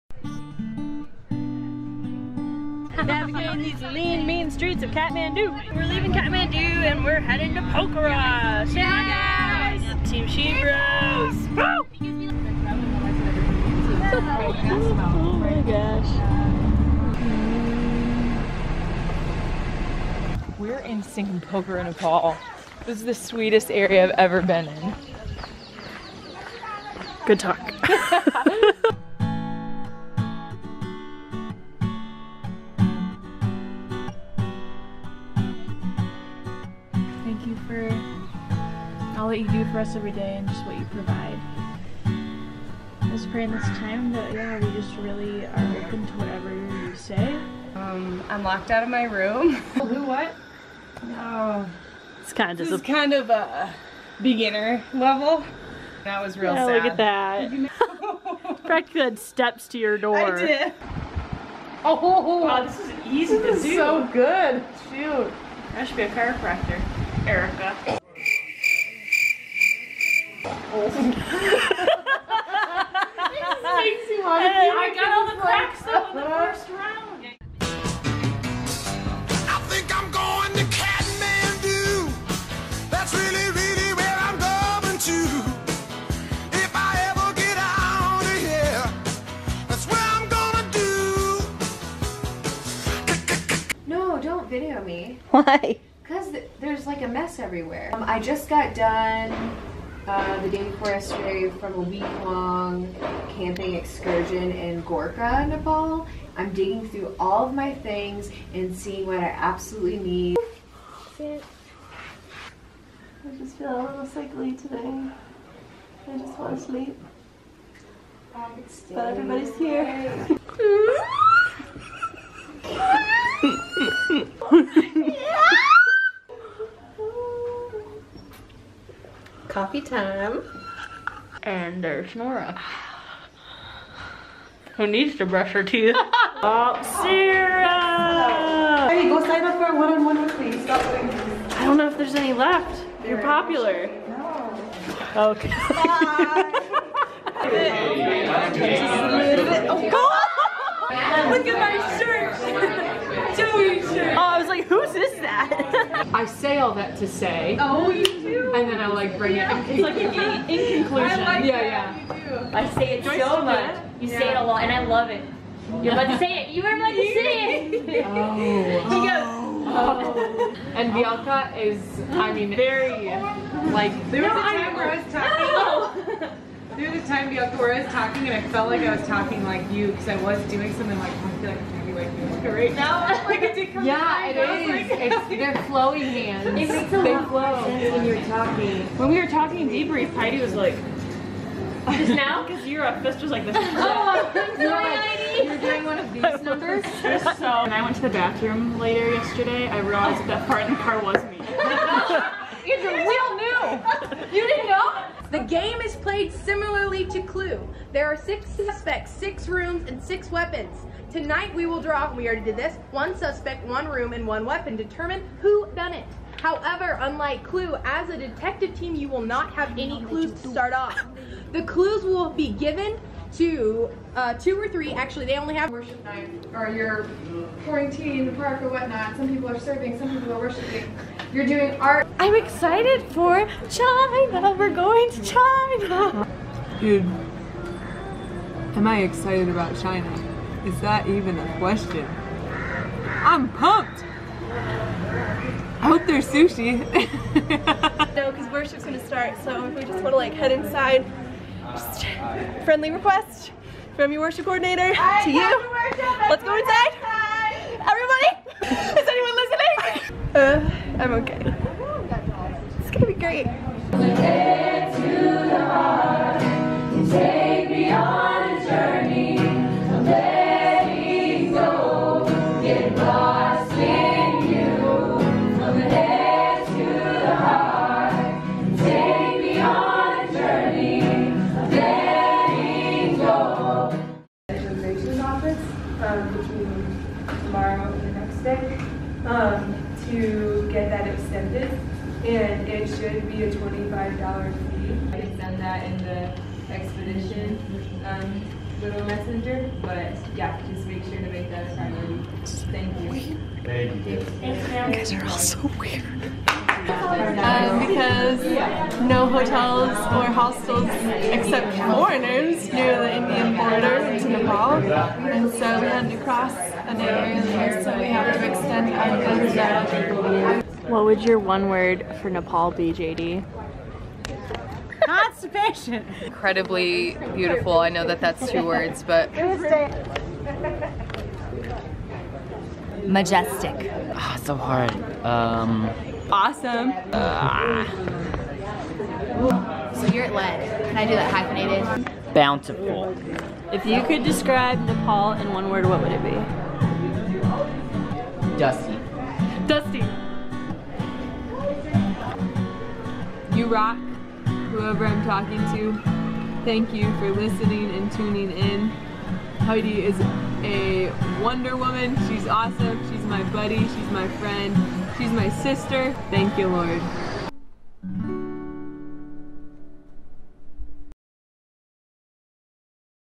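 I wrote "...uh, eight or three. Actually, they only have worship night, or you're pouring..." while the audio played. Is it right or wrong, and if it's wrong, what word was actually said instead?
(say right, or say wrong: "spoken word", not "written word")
wrong: "two", not "eight".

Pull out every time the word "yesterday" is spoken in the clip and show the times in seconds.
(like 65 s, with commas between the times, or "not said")
100 s, 199 s.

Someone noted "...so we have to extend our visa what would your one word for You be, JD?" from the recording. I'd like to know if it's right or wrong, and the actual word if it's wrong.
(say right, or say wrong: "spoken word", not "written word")
wrong: "Nepal", not "You".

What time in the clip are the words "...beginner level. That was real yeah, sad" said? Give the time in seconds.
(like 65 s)
54 s.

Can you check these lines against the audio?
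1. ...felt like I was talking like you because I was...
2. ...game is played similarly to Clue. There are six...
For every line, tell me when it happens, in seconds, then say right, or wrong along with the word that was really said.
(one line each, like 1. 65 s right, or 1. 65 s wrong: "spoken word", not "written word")
1. 178 s right
2. 205 s right.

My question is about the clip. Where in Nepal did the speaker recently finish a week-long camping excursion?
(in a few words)
Gorkha.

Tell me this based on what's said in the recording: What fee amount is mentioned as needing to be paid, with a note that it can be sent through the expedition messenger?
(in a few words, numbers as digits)
$25.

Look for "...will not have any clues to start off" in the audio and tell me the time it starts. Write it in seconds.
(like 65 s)
219 s.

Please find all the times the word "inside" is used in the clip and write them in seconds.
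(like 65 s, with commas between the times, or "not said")
250 s, 256 s.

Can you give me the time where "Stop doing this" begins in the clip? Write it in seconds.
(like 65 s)
140 s.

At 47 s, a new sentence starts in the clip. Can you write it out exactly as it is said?
Um, I'm locked out of my room.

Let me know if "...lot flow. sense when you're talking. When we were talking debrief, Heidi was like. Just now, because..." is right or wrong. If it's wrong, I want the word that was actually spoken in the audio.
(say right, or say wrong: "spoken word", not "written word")
right.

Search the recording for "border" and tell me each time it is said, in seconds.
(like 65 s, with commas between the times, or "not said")
313 s.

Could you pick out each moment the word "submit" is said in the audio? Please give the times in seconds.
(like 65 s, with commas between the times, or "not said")
not said.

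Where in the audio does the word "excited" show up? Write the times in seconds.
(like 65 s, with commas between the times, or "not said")
232 s, 239 s.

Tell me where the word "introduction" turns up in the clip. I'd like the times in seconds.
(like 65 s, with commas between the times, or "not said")
not said.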